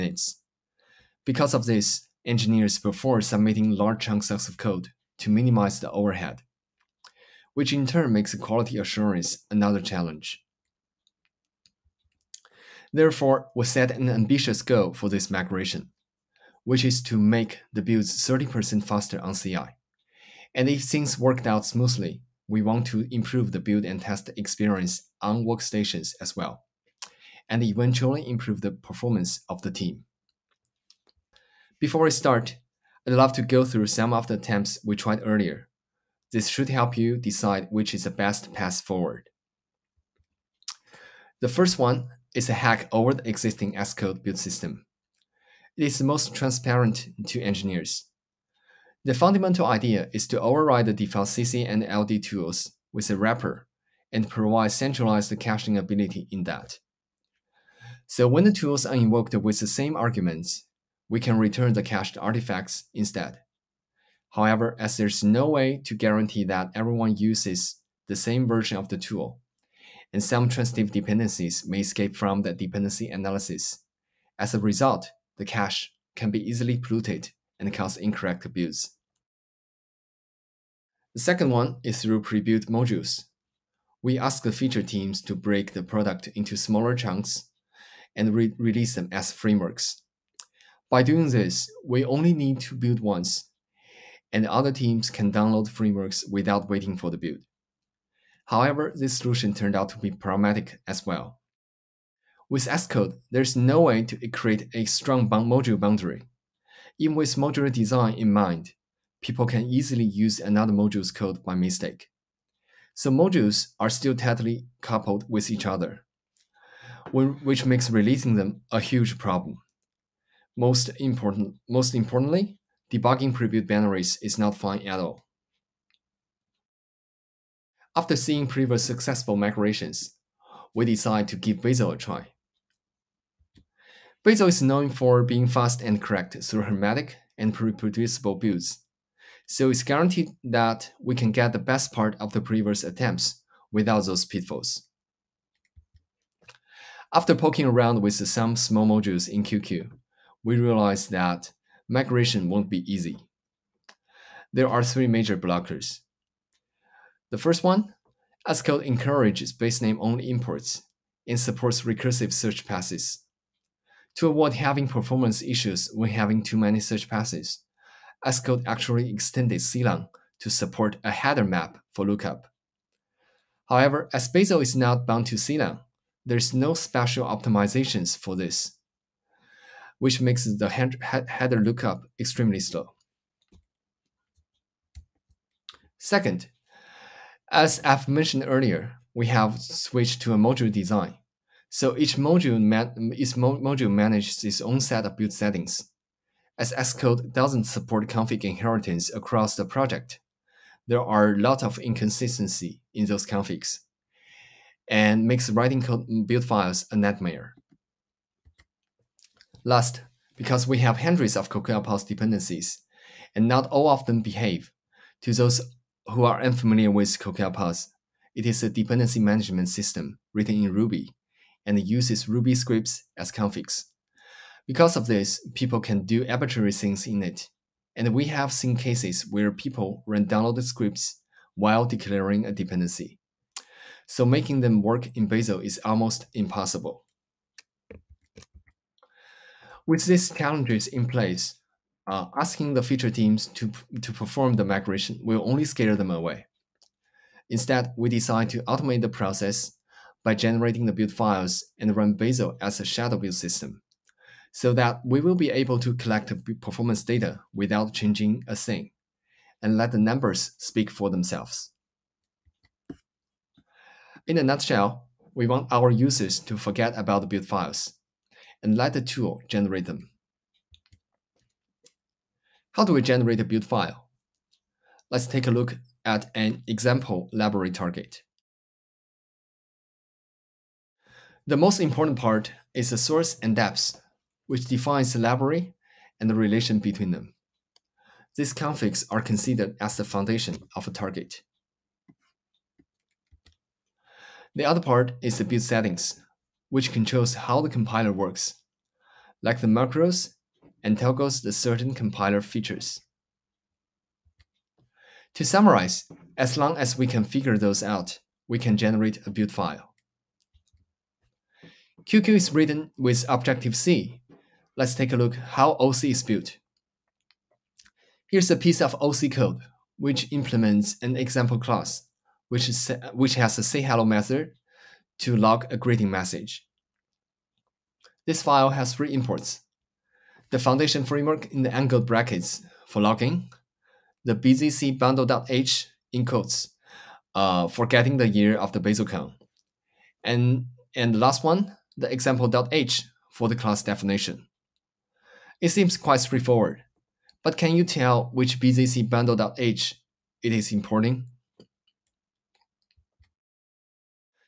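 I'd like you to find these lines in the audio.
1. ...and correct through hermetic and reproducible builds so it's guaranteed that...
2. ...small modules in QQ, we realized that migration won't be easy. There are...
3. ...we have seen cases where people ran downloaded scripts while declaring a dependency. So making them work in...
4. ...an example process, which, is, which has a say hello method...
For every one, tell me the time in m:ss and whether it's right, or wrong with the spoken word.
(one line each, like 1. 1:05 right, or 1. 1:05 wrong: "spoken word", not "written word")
1. 2:15 right
2. 2:28 right
3. 3:48 right
4. 5:21 wrong: "class", not "process".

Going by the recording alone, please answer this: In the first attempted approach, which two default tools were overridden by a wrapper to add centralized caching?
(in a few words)
CC and LD.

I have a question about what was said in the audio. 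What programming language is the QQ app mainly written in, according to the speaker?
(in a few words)
Objective-C.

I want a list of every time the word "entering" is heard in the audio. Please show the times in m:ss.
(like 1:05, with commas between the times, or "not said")
not said.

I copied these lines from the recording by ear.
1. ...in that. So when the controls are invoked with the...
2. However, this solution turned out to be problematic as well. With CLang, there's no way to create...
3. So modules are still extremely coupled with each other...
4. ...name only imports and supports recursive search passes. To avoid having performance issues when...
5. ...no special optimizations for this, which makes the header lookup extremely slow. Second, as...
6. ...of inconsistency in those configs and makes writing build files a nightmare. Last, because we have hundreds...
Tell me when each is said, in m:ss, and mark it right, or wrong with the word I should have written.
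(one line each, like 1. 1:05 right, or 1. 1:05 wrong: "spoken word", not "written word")
1. 0:56 wrong: "tools", not "controls"
2. 1:38 wrong: "Xcode", not "CLang"
3. 1:52 wrong: "tightly", not "extremely"
4. 2:39 right
5. 2:56 right
6. 3:21 right.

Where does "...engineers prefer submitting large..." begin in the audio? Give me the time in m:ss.
0:02.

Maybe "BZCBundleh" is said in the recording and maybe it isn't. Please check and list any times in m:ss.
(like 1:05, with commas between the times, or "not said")
5:34.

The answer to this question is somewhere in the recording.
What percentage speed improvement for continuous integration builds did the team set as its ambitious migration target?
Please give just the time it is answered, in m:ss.
0:18.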